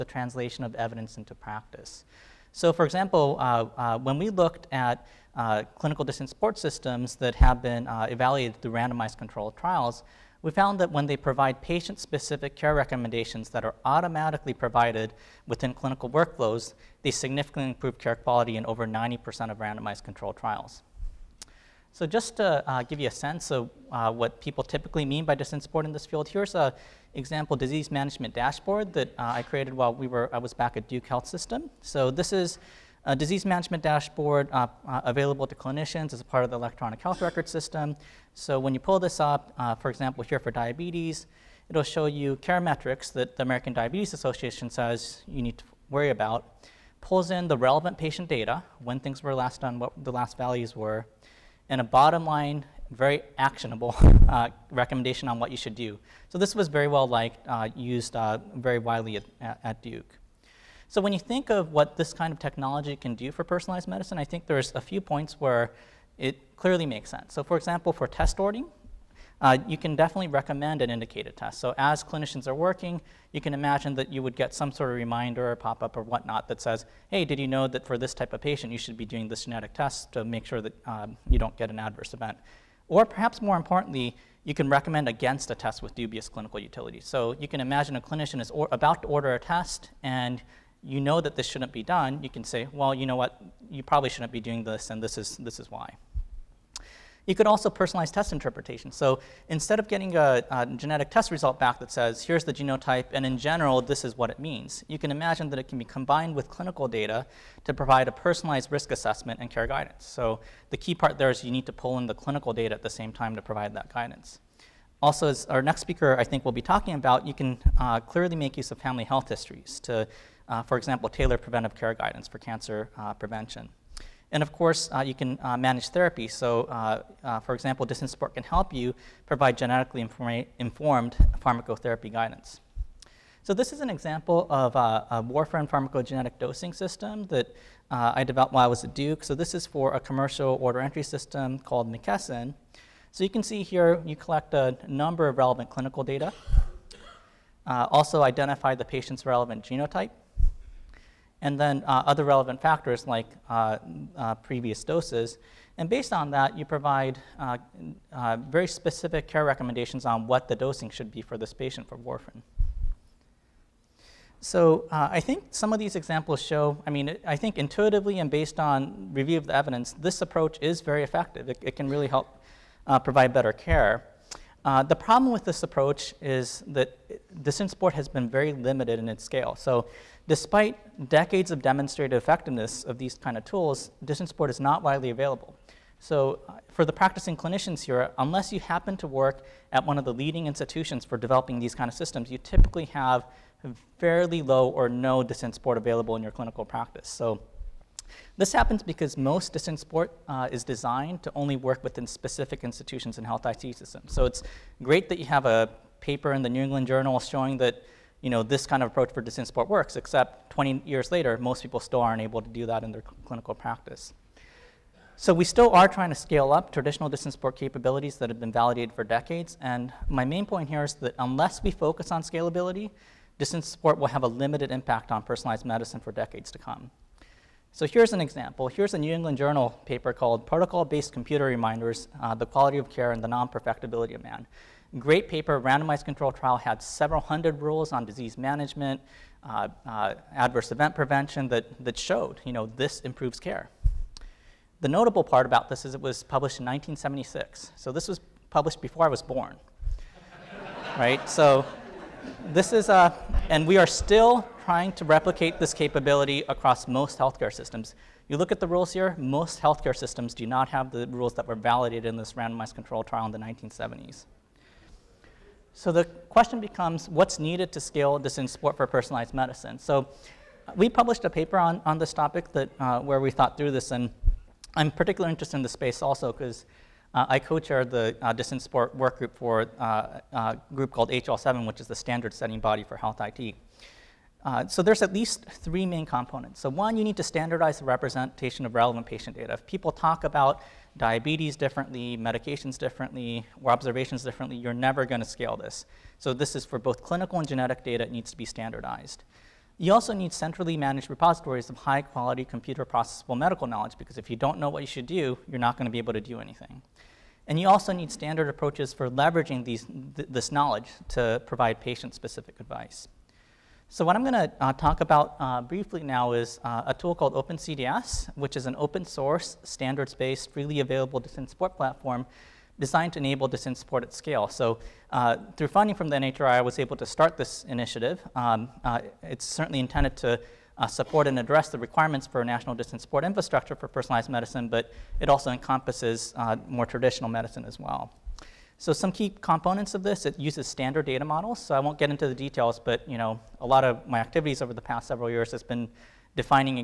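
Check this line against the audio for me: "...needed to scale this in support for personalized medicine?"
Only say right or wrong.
right.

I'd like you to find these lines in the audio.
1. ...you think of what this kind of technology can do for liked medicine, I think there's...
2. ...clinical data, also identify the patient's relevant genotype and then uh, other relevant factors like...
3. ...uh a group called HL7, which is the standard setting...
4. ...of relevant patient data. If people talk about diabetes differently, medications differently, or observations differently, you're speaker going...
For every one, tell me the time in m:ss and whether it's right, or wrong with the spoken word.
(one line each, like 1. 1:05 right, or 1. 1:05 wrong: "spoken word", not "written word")
1. 1:01 wrong: "personalized", not "liked"
2. 2:25 right
3. 4:39 right
4. 4:48 wrong: "never", not "speaker".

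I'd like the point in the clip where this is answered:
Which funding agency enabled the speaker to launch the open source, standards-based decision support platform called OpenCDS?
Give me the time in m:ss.
5:26.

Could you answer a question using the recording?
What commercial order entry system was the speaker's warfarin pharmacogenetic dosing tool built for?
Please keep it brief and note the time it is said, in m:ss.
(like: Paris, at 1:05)
McKesson, at 2:21.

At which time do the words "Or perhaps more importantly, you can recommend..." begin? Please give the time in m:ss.
1:22.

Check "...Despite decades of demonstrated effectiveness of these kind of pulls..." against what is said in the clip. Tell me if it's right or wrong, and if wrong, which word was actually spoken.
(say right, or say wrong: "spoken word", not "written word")
wrong: "tools", not "pulls".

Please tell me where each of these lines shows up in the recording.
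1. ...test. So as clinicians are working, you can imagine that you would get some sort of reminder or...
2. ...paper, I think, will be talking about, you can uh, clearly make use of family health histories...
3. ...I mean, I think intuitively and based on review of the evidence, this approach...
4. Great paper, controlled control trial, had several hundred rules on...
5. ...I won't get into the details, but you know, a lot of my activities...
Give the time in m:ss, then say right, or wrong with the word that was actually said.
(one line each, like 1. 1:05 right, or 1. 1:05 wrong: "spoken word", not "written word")
1. 1:11 right
2. 1:55 wrong: "speaker", not "paper"
3. 2:46 right
4. 3:54 wrong: "randomized", not "controlled"
5. 5:41 right.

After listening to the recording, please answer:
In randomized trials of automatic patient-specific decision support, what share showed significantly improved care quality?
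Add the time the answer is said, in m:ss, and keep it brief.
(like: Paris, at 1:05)
over 90%, at 0:18.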